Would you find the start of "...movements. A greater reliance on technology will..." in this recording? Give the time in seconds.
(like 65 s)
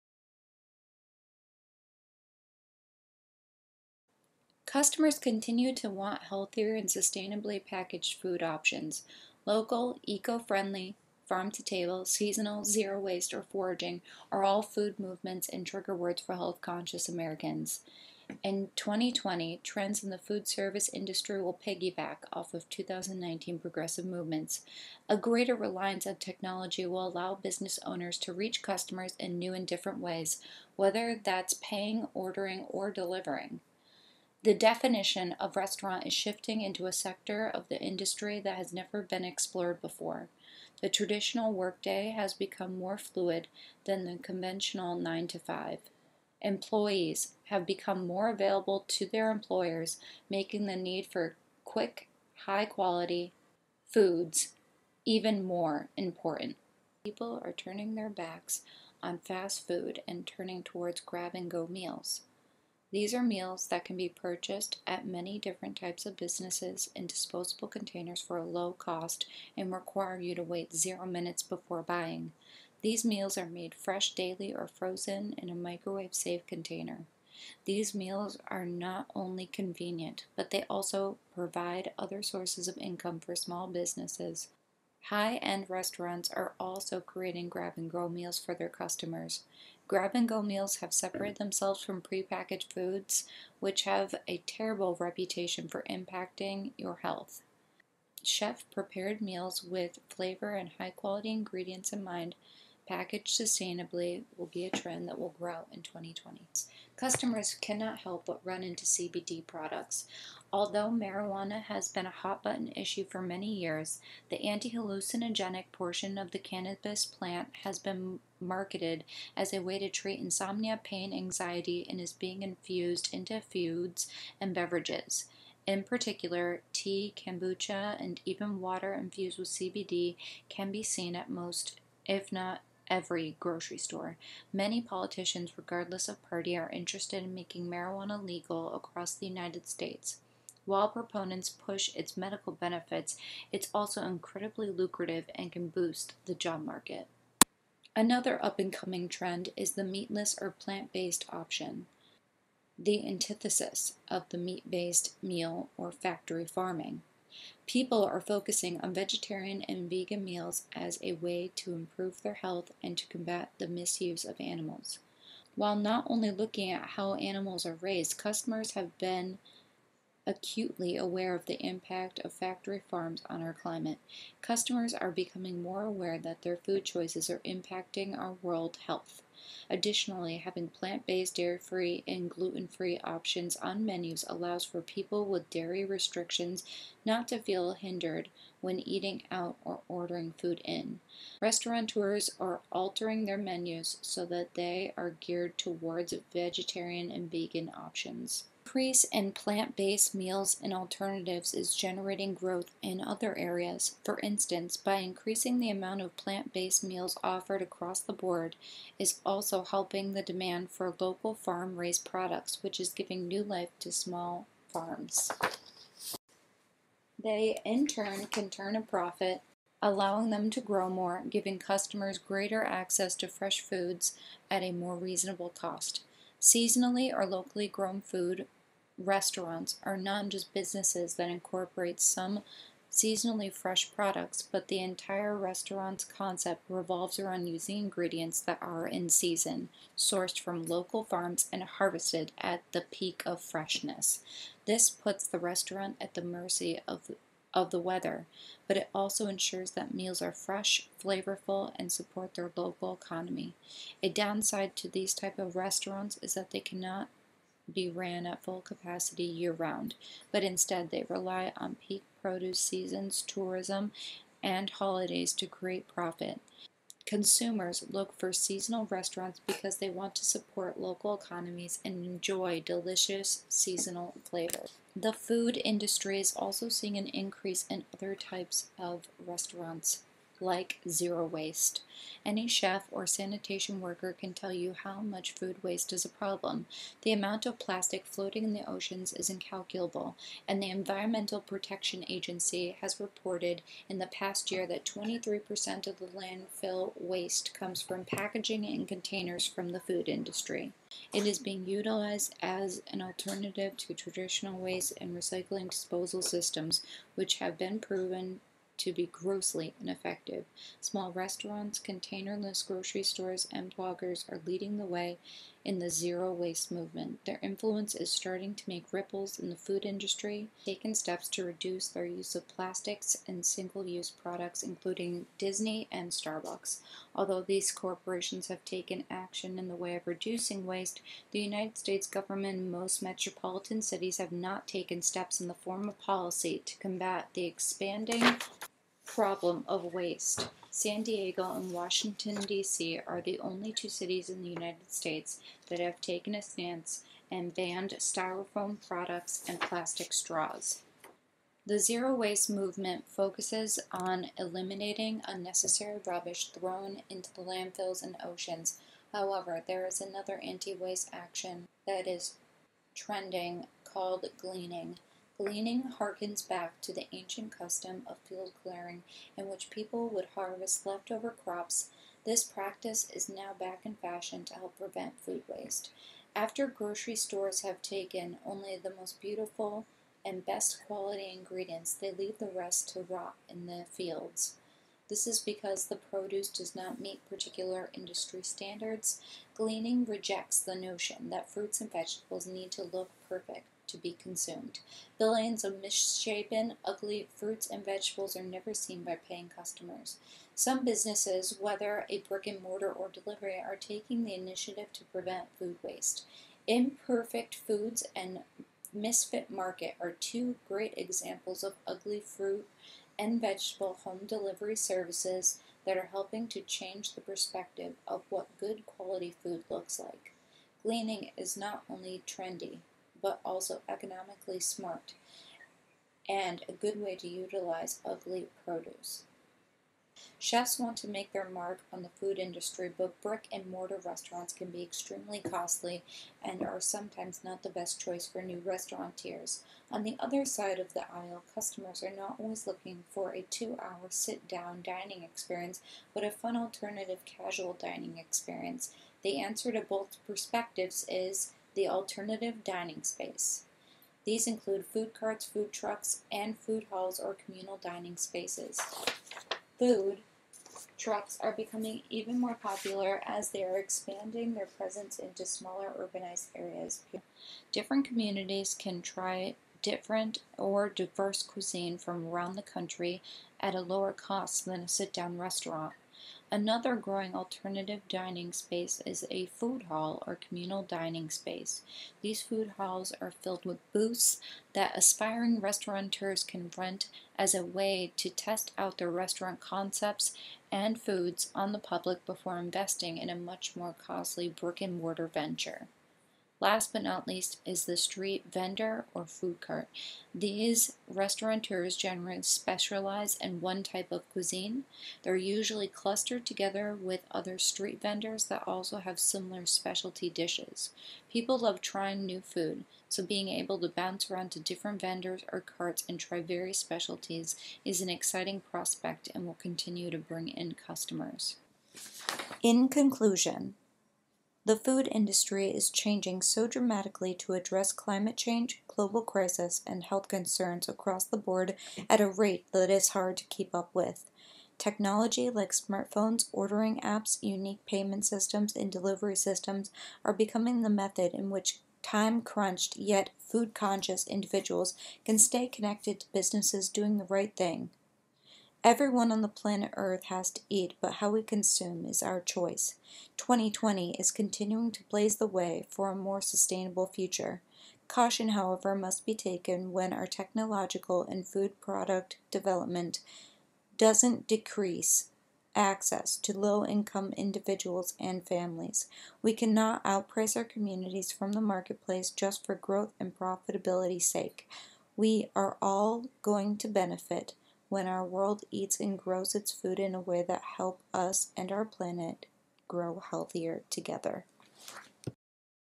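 24 s.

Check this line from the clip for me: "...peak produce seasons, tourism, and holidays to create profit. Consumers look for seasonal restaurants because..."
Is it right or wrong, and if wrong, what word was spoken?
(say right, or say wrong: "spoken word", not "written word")
right.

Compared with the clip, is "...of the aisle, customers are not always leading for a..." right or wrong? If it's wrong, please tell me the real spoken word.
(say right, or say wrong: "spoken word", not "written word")
wrong: "looking", not "leading".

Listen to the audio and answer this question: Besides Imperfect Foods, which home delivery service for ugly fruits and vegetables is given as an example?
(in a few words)
Misfit Market.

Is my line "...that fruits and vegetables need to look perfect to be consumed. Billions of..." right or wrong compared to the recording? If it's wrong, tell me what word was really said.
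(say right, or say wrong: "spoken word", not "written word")
right.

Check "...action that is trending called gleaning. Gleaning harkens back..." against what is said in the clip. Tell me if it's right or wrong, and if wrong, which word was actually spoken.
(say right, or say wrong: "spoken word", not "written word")
right.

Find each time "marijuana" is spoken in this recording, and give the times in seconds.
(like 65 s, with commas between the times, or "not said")
110 s, 137 s.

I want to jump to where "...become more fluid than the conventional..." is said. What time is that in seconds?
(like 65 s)
42 s.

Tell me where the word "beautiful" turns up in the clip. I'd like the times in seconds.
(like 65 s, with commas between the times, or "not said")
379 s.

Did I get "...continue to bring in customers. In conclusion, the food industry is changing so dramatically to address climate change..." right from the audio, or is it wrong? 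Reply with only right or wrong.
right.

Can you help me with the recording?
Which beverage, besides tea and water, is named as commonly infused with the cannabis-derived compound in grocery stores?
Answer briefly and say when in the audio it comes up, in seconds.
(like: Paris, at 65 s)
kombucha, at 127 s.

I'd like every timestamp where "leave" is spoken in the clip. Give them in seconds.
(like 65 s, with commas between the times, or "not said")
382 s.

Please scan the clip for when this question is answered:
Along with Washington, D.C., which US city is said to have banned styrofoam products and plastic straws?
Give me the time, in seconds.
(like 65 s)
340 s.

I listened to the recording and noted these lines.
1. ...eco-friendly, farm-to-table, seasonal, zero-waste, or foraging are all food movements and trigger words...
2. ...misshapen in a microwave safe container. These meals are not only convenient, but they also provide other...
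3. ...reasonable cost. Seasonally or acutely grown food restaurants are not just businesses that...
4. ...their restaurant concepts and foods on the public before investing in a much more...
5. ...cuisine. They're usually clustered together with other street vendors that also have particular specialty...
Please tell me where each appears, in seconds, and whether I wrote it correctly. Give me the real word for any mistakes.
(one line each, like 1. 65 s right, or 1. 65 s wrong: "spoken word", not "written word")
1. 10 s right
2. 74 s wrong: "frozen", not "misshapen"
3. 224 s wrong: "locally", not "acutely"
4. 488 s right
5. 504 s wrong: "similar", not "particular".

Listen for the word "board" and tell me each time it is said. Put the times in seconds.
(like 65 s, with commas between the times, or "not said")
208 s, 531 s.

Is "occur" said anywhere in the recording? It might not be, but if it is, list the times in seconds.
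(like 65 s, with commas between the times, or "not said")
not said.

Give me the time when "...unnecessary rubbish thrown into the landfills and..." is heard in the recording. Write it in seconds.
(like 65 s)
355 s.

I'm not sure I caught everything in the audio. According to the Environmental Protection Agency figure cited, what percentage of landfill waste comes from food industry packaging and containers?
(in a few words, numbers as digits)
23%.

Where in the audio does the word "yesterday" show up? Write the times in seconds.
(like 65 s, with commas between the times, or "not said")
not said.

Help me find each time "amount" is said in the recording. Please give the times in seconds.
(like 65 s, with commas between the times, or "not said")
205 s, 287 s.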